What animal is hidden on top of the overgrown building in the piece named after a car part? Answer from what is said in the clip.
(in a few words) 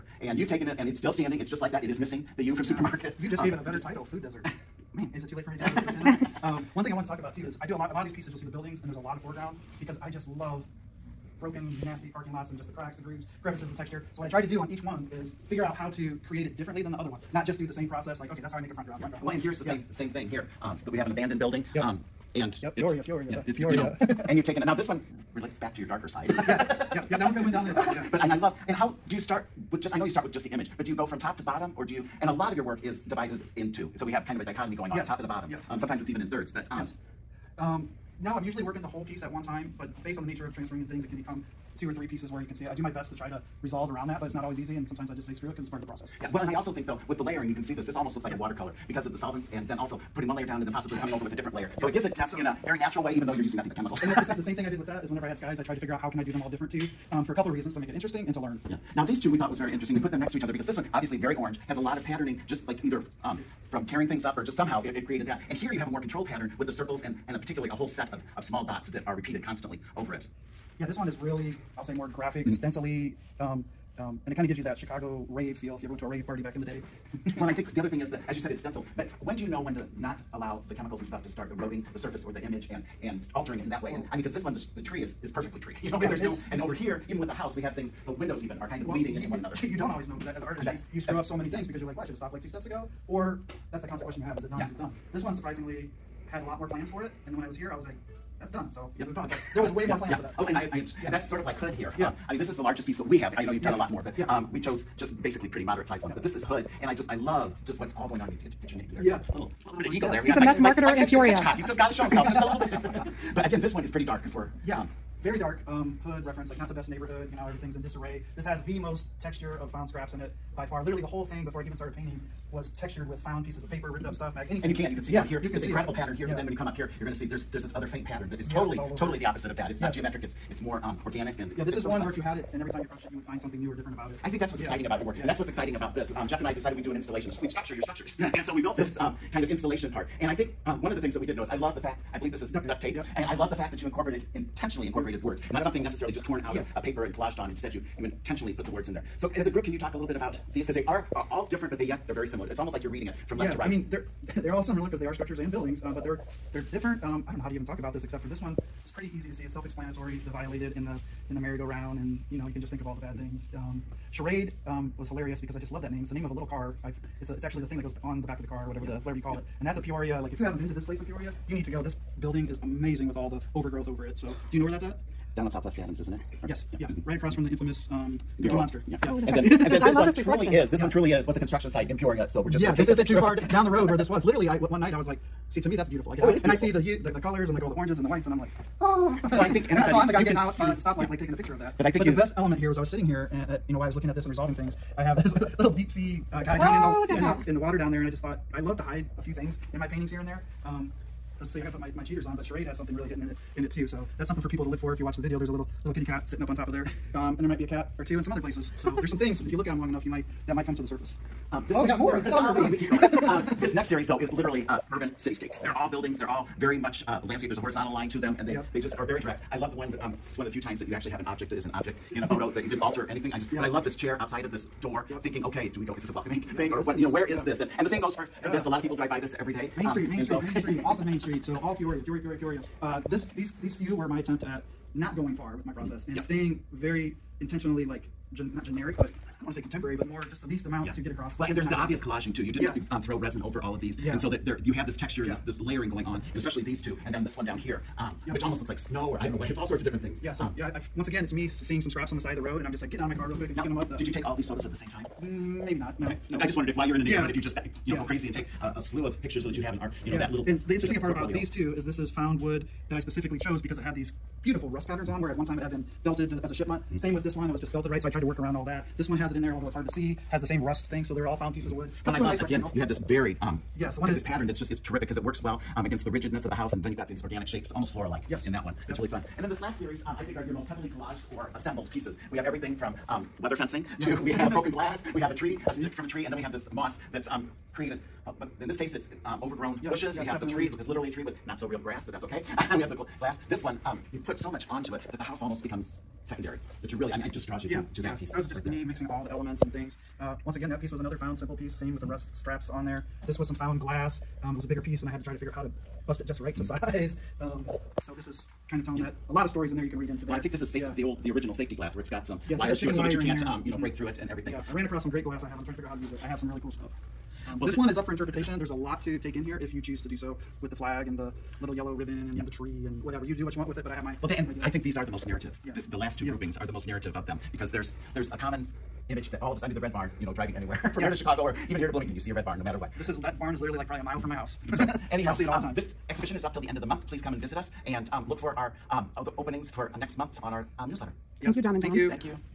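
kitty cat.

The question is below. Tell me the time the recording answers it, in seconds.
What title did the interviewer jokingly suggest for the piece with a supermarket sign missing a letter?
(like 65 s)
4 s.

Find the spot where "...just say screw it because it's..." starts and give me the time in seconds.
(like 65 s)
45 s.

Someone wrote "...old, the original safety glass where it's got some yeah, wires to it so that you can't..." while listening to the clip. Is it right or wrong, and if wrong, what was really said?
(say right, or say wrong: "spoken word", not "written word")
right.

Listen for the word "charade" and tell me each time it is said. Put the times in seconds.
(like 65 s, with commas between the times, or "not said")
164 s, 202 s.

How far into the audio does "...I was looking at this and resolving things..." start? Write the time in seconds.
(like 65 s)
193 s.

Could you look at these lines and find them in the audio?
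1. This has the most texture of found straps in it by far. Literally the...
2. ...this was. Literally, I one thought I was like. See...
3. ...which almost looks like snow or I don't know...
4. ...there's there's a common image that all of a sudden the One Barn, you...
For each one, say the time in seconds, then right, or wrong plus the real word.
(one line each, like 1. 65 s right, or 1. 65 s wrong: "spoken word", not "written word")
1. 118 s wrong: "scraps", not "straps"
2. 183 s wrong: "night", not "thought"
3. 248 s right
4. 327 s wrong: "Red", not "One".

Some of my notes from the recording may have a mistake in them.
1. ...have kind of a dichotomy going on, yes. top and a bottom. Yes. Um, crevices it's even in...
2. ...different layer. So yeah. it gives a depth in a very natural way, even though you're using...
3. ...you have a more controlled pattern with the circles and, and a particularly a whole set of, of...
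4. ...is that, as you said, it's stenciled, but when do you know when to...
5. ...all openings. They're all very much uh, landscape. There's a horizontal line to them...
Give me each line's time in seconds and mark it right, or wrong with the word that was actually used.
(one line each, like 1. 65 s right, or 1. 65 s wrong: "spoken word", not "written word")
1. 34 s wrong: "sometimes", not "crevices"
2. 51 s right
3. 65 s right
4. 78 s right
5. 215 s wrong: "buildings", not "openings".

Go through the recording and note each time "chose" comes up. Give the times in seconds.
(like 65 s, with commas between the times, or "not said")
104 s, 263 s.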